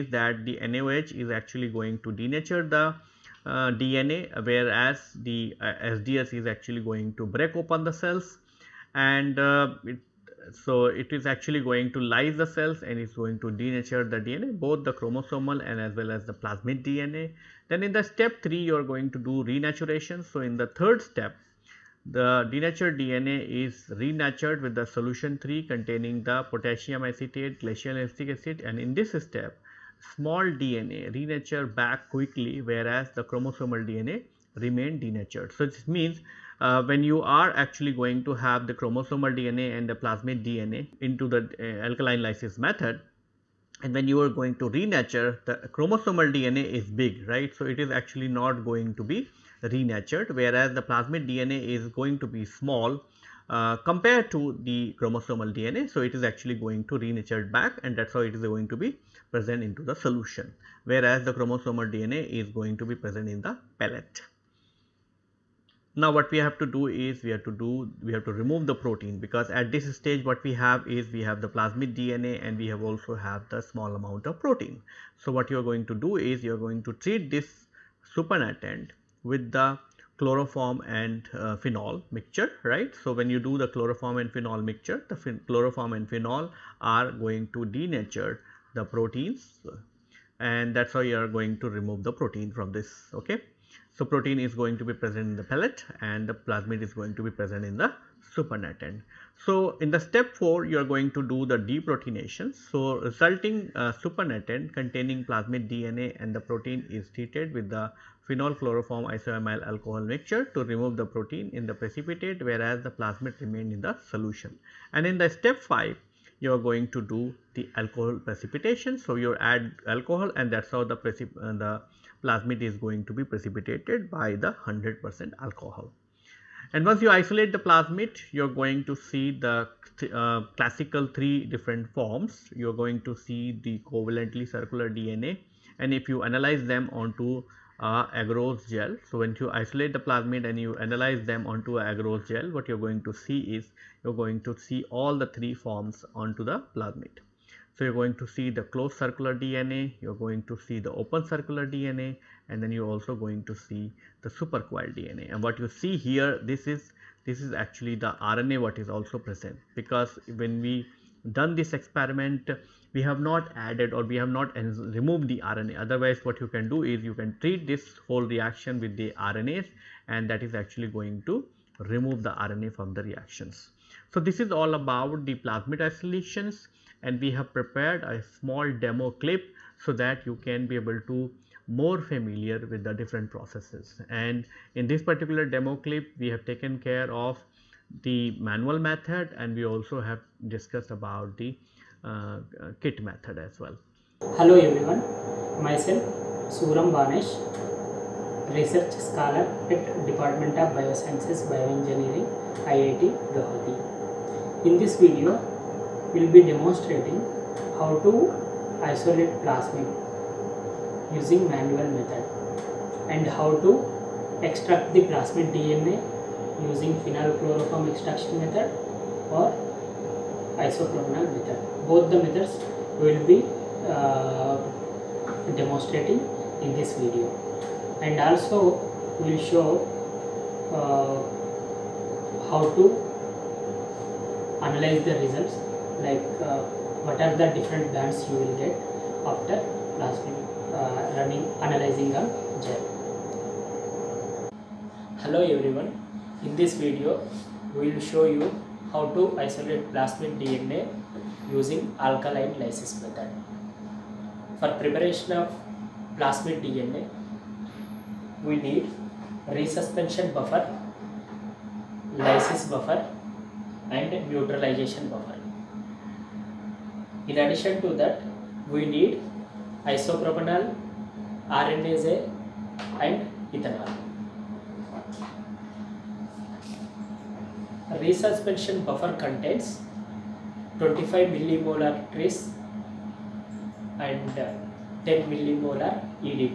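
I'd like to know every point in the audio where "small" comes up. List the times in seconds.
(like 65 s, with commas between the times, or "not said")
30 s, 52 s, 73 s, 178 s.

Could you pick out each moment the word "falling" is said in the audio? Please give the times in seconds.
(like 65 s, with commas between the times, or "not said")
not said.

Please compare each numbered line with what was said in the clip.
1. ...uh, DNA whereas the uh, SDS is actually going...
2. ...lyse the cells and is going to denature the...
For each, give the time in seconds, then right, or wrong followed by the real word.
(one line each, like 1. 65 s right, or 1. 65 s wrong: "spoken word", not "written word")
1. 3 s right
2. 11 s right.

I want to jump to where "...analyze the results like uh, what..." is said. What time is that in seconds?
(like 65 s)
234 s.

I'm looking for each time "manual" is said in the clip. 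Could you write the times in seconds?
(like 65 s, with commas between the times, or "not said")
188 s, 211 s.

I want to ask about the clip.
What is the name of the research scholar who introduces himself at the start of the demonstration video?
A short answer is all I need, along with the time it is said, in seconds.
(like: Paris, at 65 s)
Suram Banesh, at 196 s.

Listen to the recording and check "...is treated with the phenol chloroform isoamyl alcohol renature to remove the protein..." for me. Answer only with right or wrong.
wrong.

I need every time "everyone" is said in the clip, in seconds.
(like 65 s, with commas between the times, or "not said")
194 s, 245 s.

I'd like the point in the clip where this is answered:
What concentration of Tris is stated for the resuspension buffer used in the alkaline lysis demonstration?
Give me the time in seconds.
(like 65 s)
280 s.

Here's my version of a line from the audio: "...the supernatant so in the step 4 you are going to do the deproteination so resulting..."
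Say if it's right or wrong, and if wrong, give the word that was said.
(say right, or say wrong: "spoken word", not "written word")
right.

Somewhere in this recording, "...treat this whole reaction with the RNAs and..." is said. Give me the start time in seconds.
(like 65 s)
167 s.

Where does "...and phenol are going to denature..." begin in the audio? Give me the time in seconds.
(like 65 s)
85 s.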